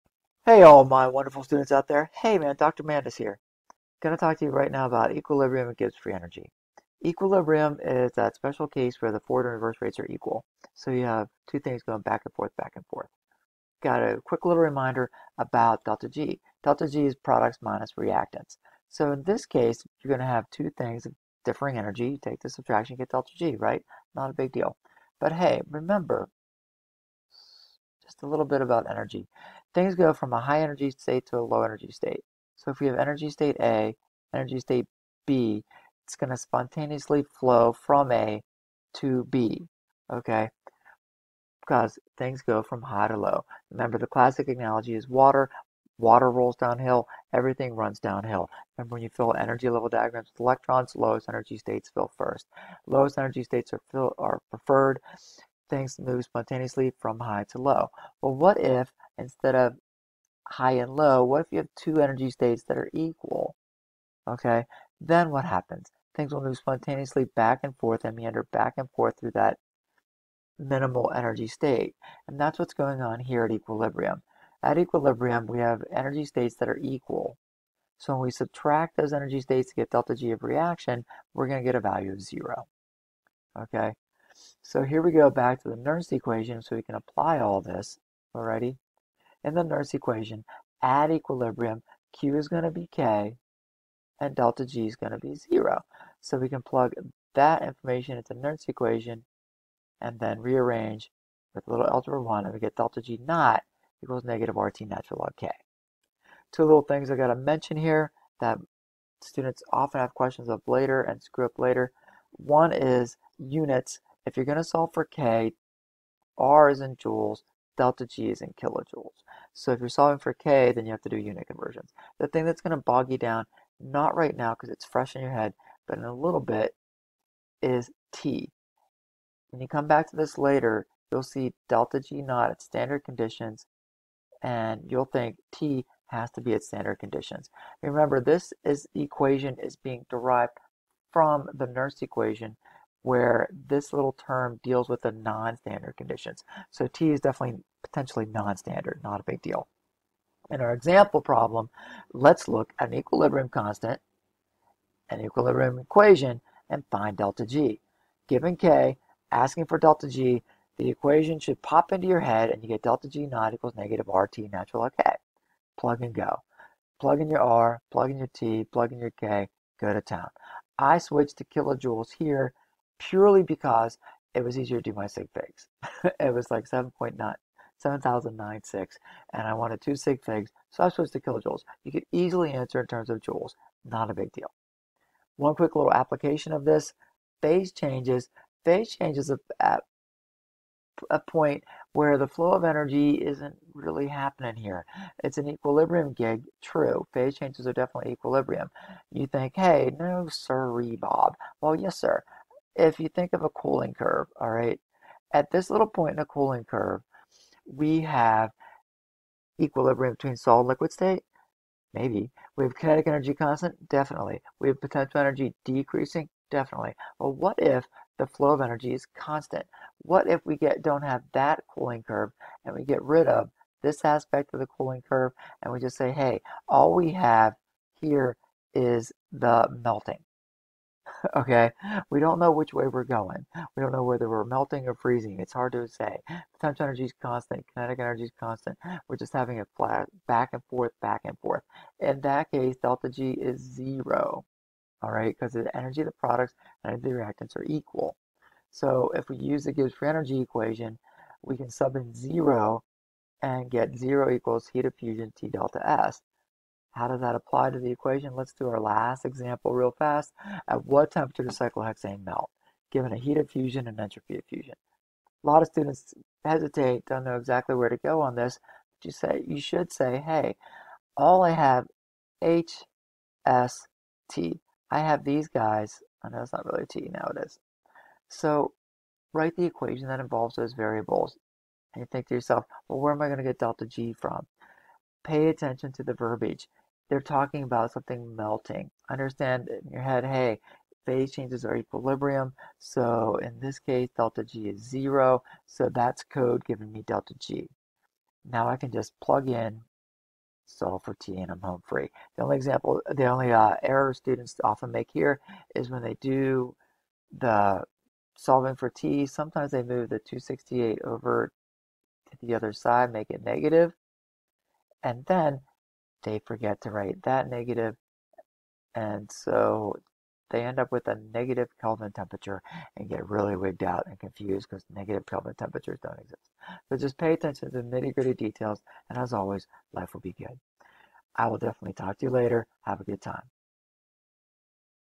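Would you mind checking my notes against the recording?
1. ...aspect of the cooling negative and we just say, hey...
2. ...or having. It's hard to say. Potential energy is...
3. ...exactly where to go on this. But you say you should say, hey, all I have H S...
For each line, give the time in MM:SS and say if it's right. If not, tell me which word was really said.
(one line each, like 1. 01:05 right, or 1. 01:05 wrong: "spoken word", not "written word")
1. 03:44 wrong: "curve", not "negative"
2. 03:54 wrong: "freezing", not "having"
3. 04:27 right.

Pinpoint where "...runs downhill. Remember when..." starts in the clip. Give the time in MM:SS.
00:47.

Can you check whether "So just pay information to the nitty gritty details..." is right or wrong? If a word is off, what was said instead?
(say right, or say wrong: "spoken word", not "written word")
wrong: "attention", not "information".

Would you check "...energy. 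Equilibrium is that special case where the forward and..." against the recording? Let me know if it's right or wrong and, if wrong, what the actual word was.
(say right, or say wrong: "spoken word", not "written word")
right.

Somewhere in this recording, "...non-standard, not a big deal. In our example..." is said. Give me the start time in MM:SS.
02:28.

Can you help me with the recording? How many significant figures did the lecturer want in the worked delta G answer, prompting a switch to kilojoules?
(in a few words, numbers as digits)
2.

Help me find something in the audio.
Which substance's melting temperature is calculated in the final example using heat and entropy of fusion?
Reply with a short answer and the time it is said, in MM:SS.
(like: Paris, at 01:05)
cyclohexane, at 04:21.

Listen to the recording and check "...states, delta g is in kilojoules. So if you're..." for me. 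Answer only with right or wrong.
wrong.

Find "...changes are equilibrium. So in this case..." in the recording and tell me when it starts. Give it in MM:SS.
04:51.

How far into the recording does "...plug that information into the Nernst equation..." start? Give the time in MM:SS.
01:36.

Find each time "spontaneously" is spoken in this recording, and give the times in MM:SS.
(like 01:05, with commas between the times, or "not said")
00:36, 00:56, 01:06.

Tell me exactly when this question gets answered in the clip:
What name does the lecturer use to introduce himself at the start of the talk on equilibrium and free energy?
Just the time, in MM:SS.
00:02.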